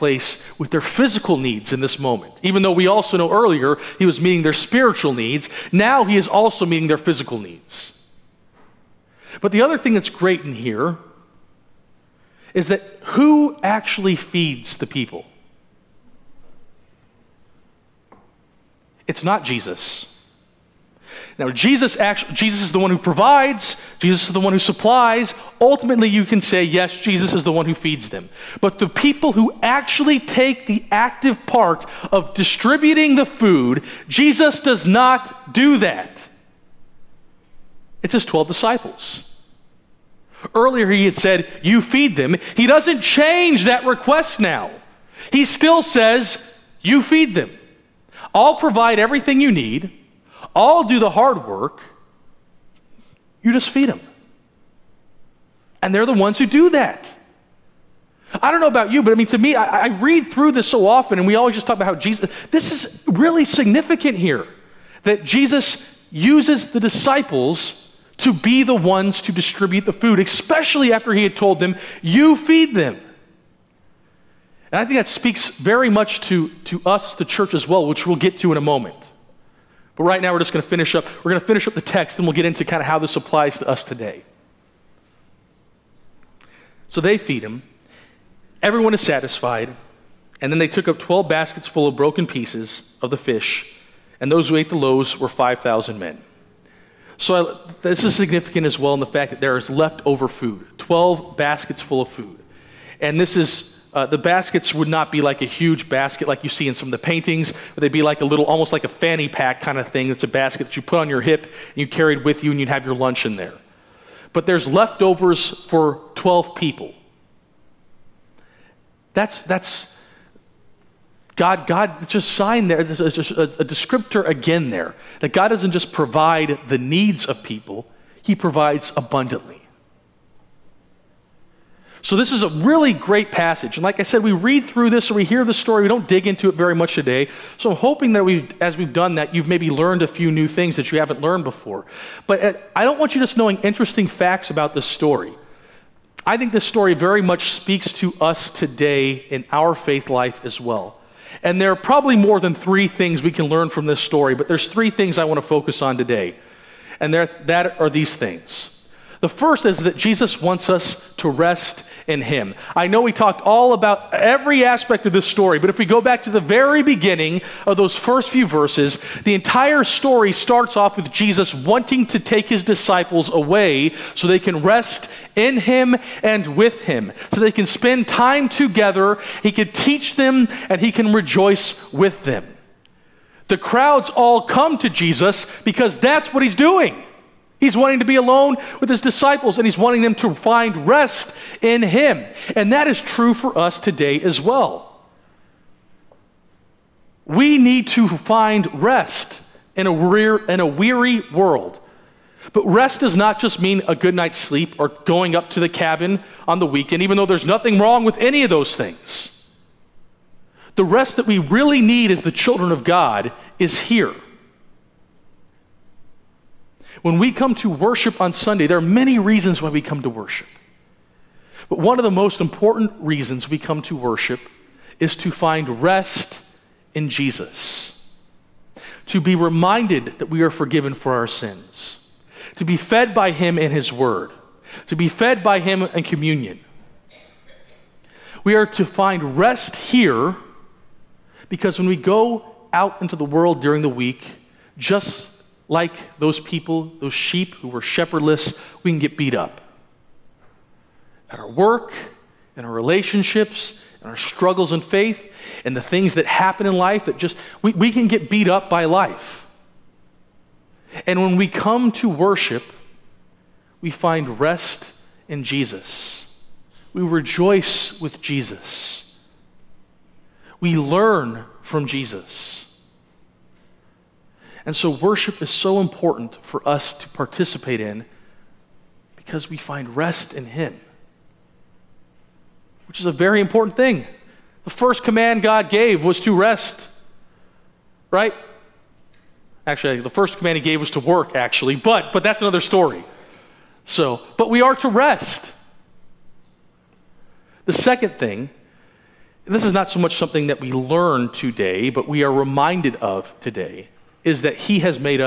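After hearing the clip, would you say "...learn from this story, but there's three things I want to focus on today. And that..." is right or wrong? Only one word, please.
right.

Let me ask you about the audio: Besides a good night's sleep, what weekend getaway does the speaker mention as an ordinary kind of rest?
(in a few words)
the cabin.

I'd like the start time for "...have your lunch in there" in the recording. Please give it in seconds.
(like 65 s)
112 s.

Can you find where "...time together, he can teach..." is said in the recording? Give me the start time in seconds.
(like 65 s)
178 s.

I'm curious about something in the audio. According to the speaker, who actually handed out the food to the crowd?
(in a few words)
12 disciples.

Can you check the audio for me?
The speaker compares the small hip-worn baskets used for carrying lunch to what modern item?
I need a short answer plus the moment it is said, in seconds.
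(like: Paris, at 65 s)
a fanny pack, at 108 s.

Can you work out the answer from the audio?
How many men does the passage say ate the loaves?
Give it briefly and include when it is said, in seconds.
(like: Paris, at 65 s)
5,000, at 95 s.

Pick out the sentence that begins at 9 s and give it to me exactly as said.
But the other thing that's great in here is that who actually feeds the people?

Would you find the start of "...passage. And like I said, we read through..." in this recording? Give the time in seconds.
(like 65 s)
133 s.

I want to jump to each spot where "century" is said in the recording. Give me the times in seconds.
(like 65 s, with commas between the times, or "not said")
not said.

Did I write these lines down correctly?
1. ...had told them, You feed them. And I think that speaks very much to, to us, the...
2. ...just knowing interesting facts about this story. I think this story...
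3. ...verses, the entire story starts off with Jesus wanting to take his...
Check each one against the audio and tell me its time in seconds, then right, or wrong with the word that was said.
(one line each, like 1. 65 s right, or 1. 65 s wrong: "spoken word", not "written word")
1. 71 s right
2. 143 s right
3. 168 s right.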